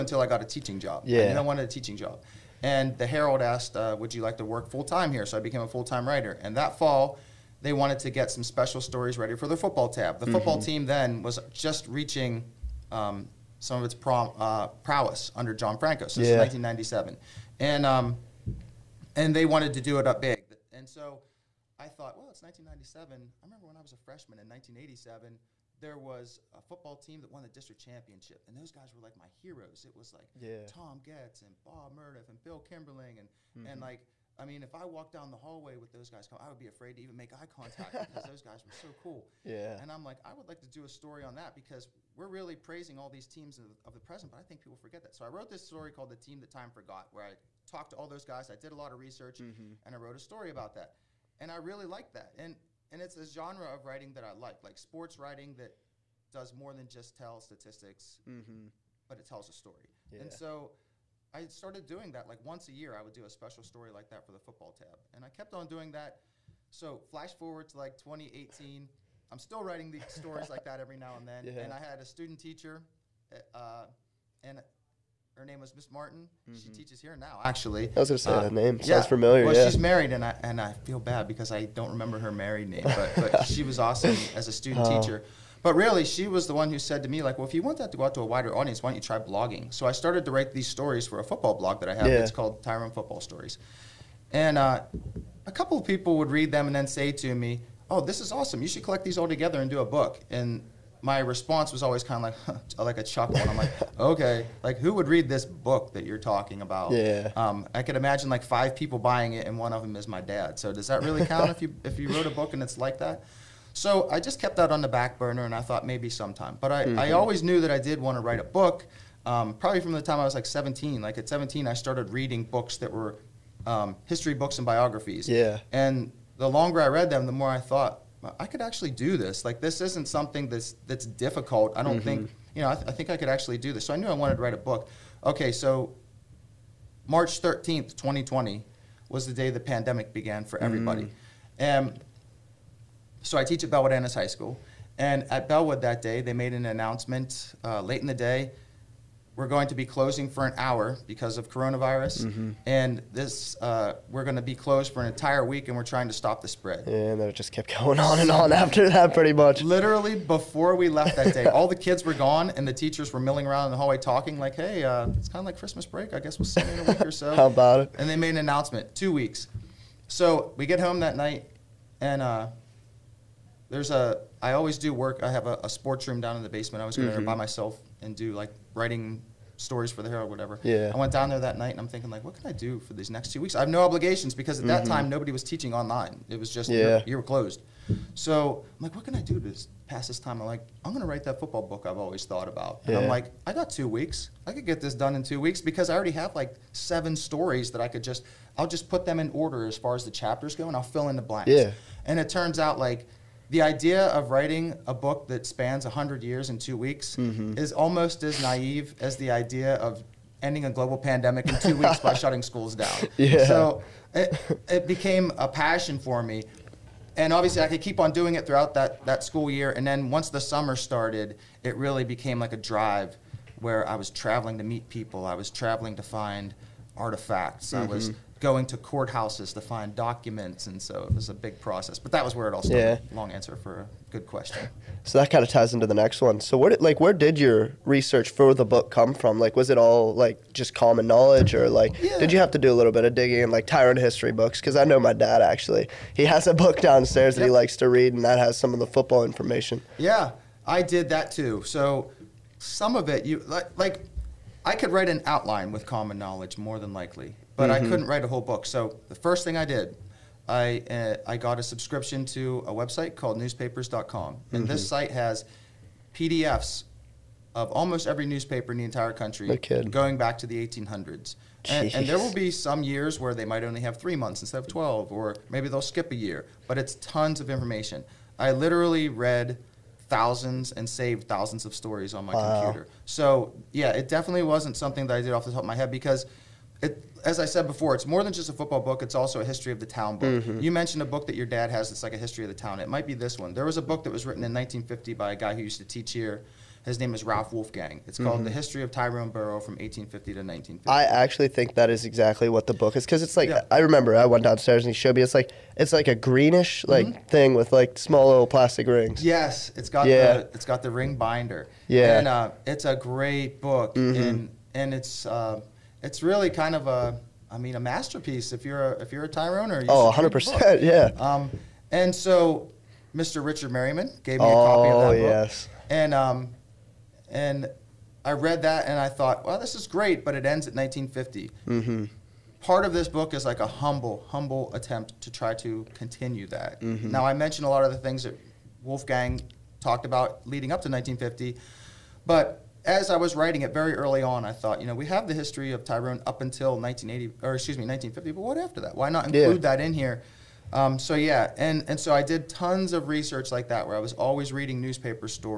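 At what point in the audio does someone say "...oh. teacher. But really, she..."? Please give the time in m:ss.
1:24.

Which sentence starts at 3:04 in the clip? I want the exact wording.
that time nobody was teaching online.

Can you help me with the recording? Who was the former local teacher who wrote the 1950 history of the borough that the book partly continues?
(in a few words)
Ralph Wolfgang.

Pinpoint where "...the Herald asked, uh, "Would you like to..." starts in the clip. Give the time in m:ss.
0:02.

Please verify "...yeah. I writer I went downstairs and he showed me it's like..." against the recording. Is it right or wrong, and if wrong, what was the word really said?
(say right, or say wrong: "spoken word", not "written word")
wrong: "remember", not "writer".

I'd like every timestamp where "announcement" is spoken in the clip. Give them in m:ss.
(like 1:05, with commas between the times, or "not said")
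2:26, 2:48.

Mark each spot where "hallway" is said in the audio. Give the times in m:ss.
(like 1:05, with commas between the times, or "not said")
0:35, 2:43.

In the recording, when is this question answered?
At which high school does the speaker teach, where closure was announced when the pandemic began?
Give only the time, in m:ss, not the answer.
2:23.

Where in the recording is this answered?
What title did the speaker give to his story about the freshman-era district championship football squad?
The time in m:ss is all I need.
0:46.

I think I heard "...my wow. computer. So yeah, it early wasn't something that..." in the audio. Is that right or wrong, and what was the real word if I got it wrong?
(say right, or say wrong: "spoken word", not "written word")
wrong: "definitely", not "early".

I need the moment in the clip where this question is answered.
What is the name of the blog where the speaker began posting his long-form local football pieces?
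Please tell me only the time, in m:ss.
1:32.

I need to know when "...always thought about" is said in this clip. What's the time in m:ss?
3:11.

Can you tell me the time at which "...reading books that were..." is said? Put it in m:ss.
2:02.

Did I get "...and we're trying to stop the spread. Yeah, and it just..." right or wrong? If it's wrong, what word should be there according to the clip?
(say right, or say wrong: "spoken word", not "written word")
right.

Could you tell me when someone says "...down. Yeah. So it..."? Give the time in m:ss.
3:32.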